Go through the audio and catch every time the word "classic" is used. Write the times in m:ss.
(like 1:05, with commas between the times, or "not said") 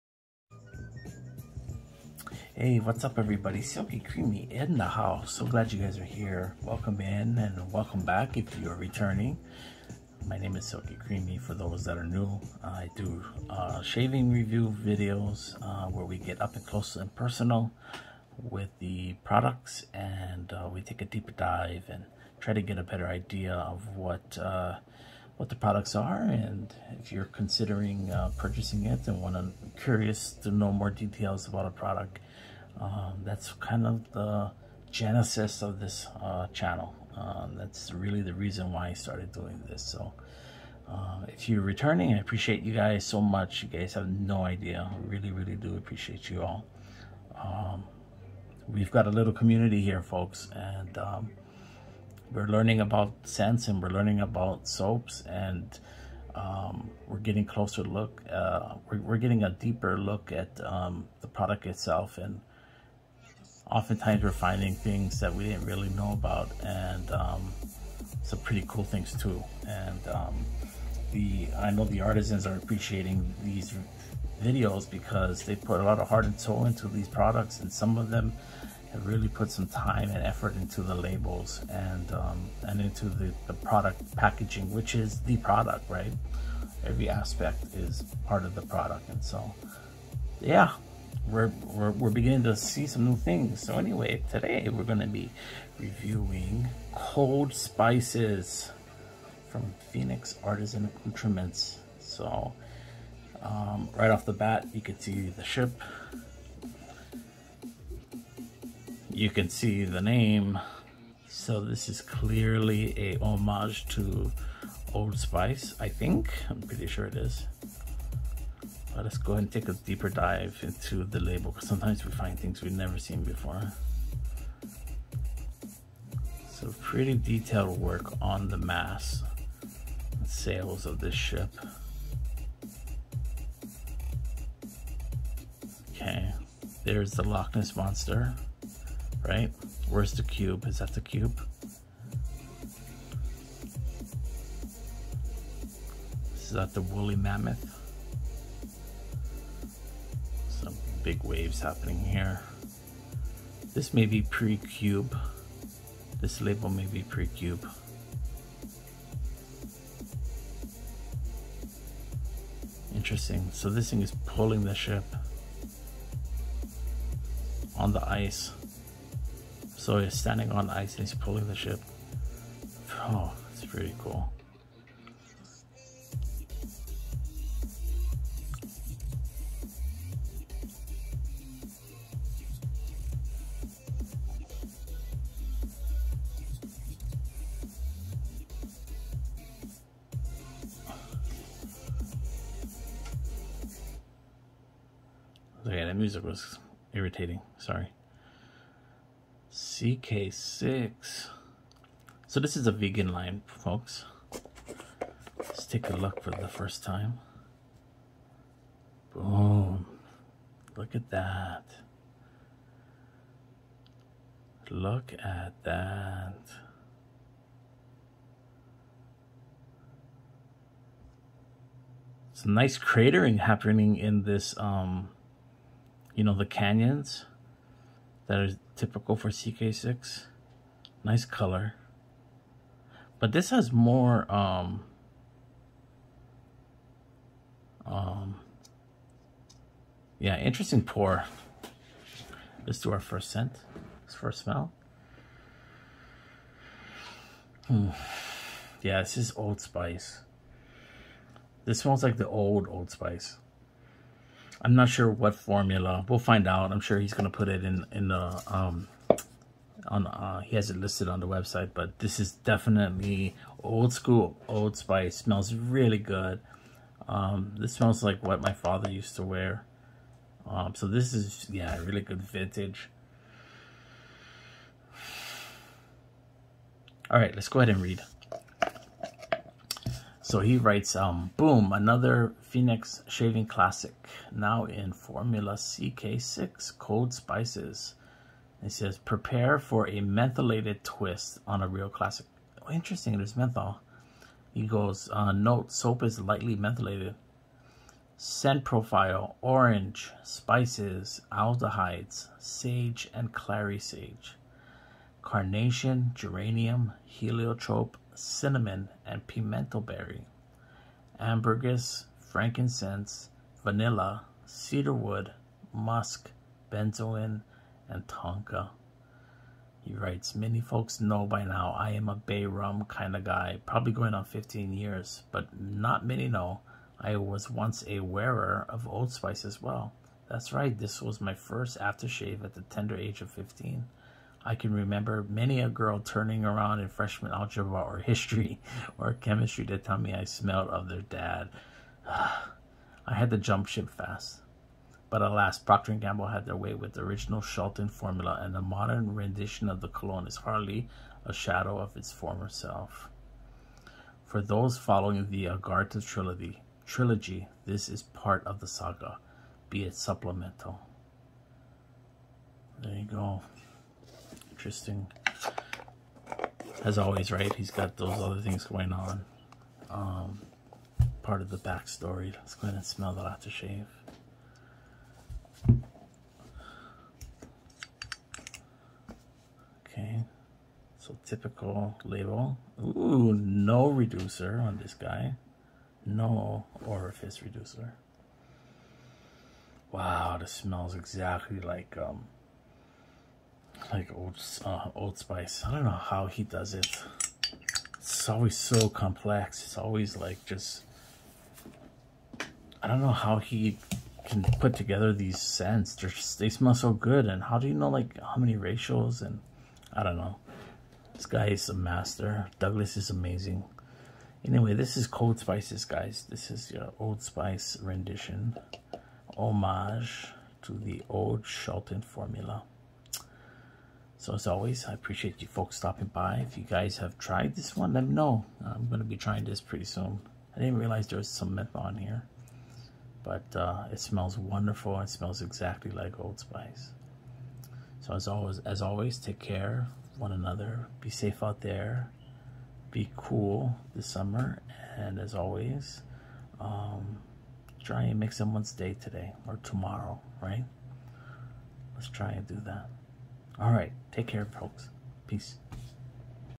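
4:43, 4:51.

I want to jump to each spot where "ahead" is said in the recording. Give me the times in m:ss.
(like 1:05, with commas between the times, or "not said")
1:59, 4:37, 6:12.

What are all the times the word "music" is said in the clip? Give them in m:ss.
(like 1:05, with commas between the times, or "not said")
3:15.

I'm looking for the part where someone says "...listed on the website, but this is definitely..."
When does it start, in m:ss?
4:20.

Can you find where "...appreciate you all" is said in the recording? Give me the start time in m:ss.
0:45.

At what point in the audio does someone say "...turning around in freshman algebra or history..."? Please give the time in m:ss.
5:35.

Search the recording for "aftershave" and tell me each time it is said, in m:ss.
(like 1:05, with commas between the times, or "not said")
5:31, 6:13.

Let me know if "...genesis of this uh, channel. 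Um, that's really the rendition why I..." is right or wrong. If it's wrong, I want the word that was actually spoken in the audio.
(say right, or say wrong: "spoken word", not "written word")
wrong: "reason", not "rendition".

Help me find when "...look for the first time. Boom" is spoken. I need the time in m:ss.
3:25.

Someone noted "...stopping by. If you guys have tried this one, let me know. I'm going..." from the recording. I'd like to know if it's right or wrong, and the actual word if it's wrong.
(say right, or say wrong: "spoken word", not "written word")
right.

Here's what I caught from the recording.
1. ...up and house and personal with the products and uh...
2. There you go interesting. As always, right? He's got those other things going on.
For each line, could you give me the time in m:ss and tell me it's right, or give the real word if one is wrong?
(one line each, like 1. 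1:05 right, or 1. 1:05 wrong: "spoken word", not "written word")
1. 0:16 wrong: "close", not "house"
2. 6:02 right.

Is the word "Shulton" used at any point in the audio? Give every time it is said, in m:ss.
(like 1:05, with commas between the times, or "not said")
5:47, 7:01.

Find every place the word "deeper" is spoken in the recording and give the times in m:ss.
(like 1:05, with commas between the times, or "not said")
0:21, 0:59, 1:59.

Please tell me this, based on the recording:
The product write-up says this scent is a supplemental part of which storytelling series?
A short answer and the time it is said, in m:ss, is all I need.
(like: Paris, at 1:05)
Agartha trilogy, at 5:55.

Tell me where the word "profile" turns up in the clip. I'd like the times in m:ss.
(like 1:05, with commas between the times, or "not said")
4:58.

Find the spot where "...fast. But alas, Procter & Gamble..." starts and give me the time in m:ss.
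5:43.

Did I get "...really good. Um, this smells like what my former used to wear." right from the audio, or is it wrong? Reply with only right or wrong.
wrong.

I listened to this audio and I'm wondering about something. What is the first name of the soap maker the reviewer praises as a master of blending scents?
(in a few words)
Douglas.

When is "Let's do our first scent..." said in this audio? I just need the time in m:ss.
4:02.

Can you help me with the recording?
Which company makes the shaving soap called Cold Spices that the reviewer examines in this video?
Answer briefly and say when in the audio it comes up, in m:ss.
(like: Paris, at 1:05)
Phoenix Artisan Accoutrements, at 1:39.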